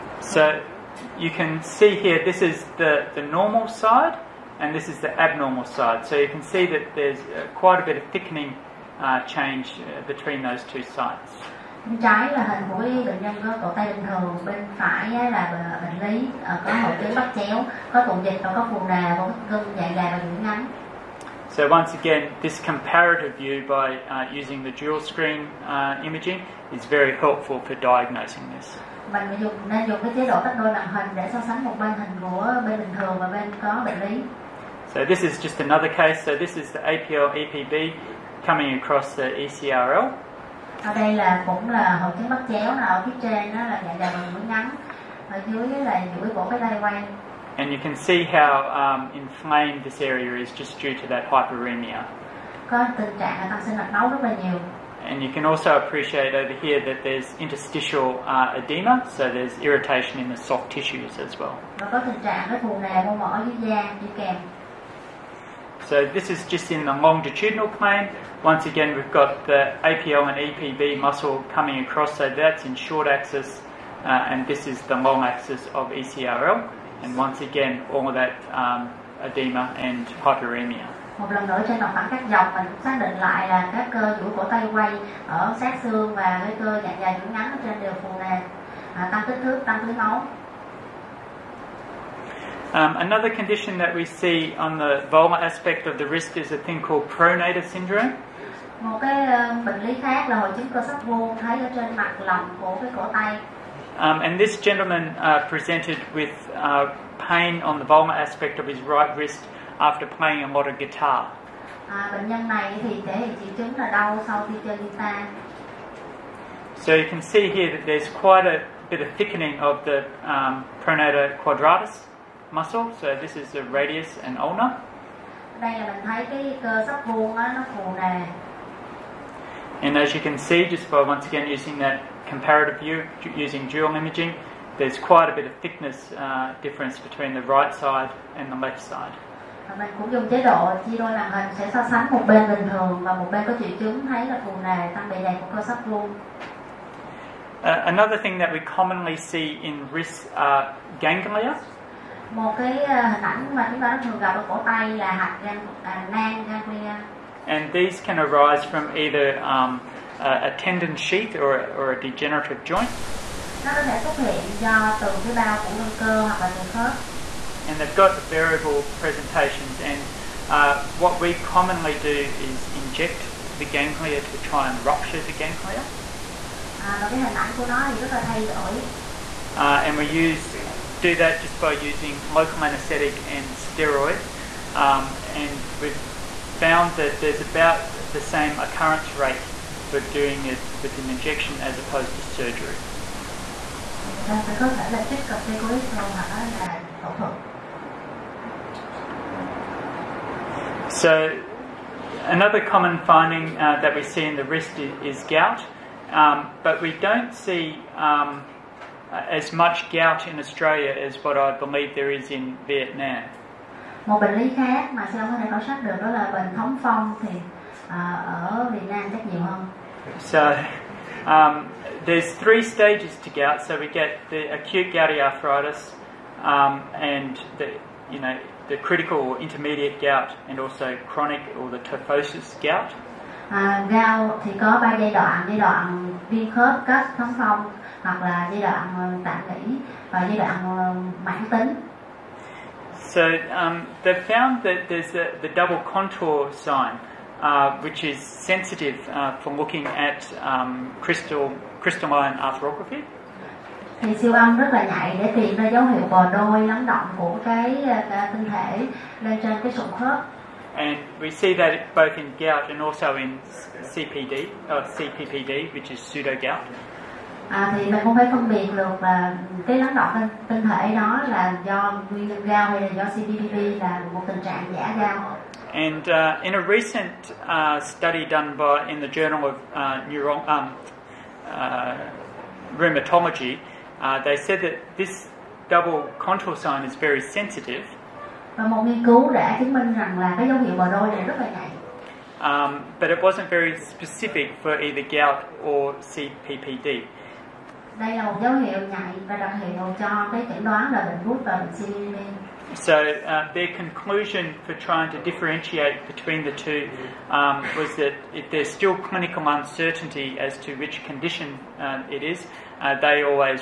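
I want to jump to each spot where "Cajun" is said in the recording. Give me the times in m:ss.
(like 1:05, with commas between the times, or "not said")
not said.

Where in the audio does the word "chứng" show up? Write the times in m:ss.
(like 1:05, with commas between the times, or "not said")
0:16, 0:42, 1:40, 1:53, 2:23, 4:49.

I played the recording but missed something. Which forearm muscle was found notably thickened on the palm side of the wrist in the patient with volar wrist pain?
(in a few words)
Pronator quadratus.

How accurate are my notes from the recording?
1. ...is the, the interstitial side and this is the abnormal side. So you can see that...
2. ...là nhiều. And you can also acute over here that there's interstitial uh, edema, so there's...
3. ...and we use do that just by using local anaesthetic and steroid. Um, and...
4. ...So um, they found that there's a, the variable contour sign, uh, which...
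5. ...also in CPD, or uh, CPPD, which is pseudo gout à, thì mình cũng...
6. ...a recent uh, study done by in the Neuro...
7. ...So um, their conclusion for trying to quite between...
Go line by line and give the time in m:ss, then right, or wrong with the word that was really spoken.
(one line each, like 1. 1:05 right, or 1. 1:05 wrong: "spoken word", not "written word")
1. 0:02 wrong: "normal", not "interstitial"
2. 0:54 wrong: "appreciate", not "acute"
3. 2:59 right
4. 4:03 wrong: "double", not "variable"
5. 4:22 right
6. 4:36 wrong: "Journal", not "Neuro"
7. 5:02 wrong: "differentiate", not "quite".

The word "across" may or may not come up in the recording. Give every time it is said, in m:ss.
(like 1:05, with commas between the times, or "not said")
0:38, 1:11.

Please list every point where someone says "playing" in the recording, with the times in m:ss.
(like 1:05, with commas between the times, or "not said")
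1:50.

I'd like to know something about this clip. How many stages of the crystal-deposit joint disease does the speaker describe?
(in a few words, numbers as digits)
3.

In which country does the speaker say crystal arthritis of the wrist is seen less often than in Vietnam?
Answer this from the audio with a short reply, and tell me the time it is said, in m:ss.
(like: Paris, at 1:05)
Australia, at 3:30.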